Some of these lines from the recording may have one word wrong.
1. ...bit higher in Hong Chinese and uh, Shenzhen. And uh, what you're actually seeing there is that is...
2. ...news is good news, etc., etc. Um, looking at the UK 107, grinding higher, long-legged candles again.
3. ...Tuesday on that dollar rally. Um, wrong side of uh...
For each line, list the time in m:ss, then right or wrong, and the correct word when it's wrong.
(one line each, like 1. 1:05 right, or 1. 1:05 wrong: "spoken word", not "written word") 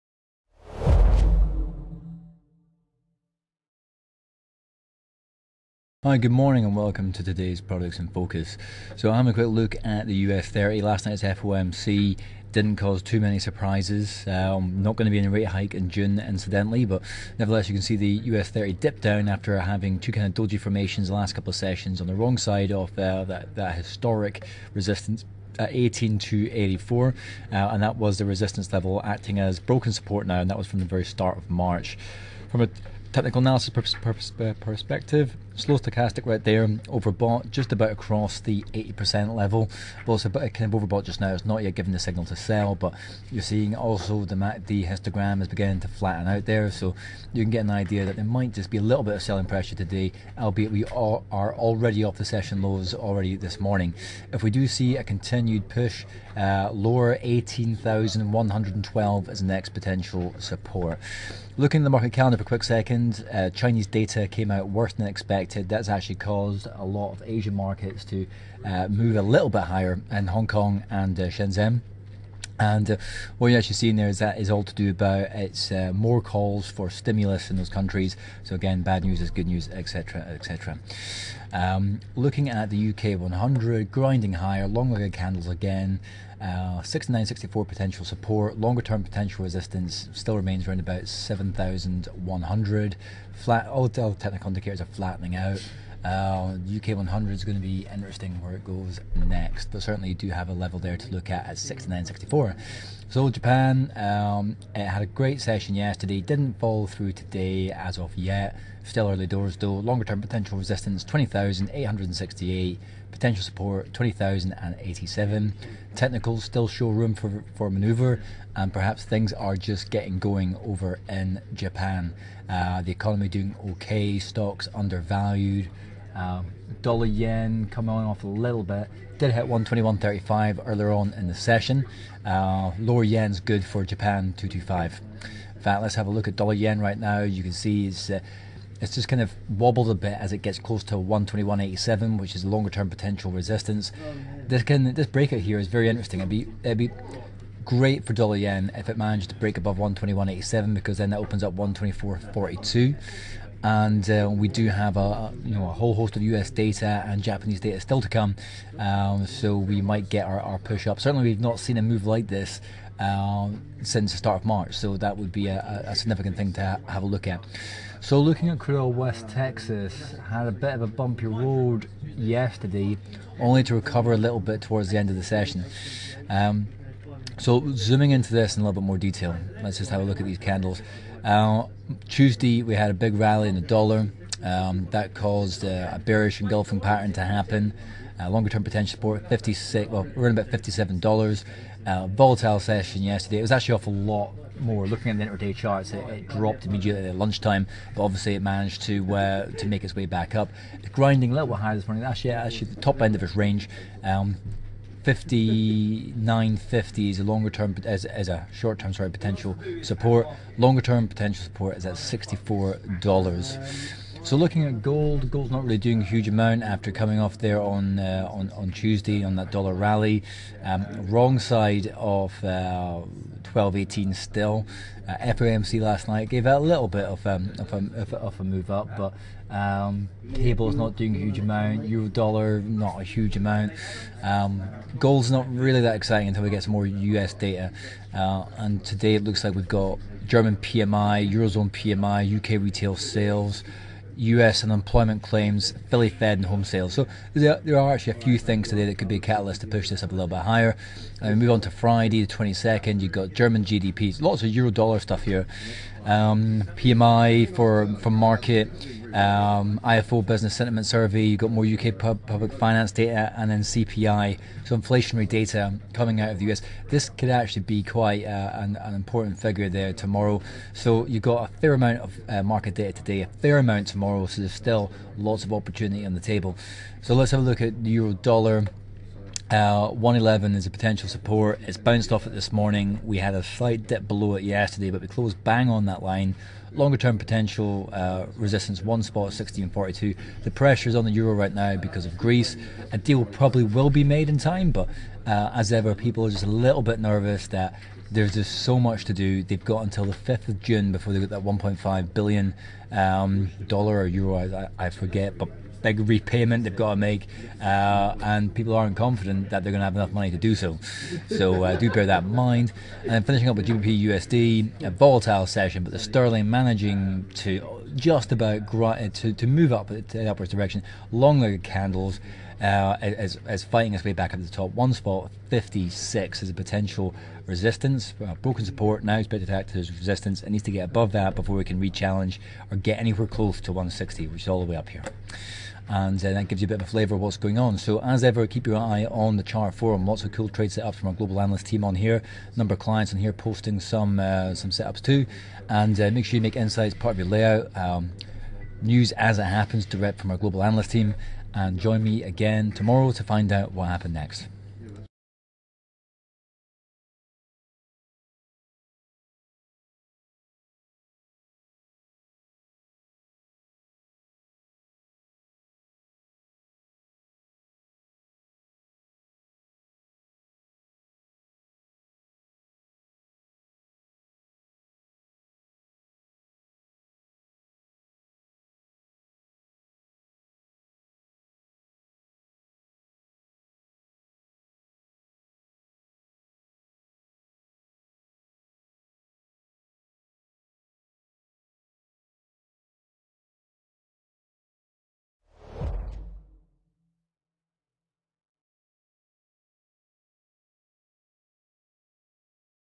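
1. 1:09 wrong: "Kong", not "Chinese"
2. 1:19 wrong: "100", not "107"
3. 3:38 right.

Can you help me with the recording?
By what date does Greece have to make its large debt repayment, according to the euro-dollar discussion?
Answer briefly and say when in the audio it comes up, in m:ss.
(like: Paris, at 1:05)
5th of June, at 5:00.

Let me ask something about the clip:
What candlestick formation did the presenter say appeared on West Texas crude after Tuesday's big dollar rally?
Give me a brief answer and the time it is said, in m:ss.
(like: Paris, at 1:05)
Bearish engulfing pattern, at 3:05.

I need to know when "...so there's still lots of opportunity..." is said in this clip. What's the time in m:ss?
4:34.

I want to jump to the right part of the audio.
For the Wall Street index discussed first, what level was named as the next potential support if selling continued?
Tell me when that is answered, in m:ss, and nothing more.
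0:57.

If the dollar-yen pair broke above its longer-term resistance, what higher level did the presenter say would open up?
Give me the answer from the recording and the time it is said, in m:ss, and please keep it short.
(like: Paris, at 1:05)
124.42, at 2:31.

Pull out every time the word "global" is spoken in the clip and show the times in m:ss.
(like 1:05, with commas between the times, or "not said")
5:41, 5:50.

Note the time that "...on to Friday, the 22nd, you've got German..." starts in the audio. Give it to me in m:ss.
4:11.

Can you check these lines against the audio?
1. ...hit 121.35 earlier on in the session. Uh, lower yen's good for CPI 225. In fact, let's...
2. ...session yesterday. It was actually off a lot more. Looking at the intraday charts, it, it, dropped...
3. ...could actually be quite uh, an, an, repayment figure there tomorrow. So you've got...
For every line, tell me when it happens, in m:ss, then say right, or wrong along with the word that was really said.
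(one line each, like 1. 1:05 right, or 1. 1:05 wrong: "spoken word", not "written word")
1. 2:09 wrong: "Japan", not "CPI"
2. 3:12 right
3. 4:27 wrong: "important", not "repayment".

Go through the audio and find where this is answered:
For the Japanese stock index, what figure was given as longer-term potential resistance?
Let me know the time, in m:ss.
1:51.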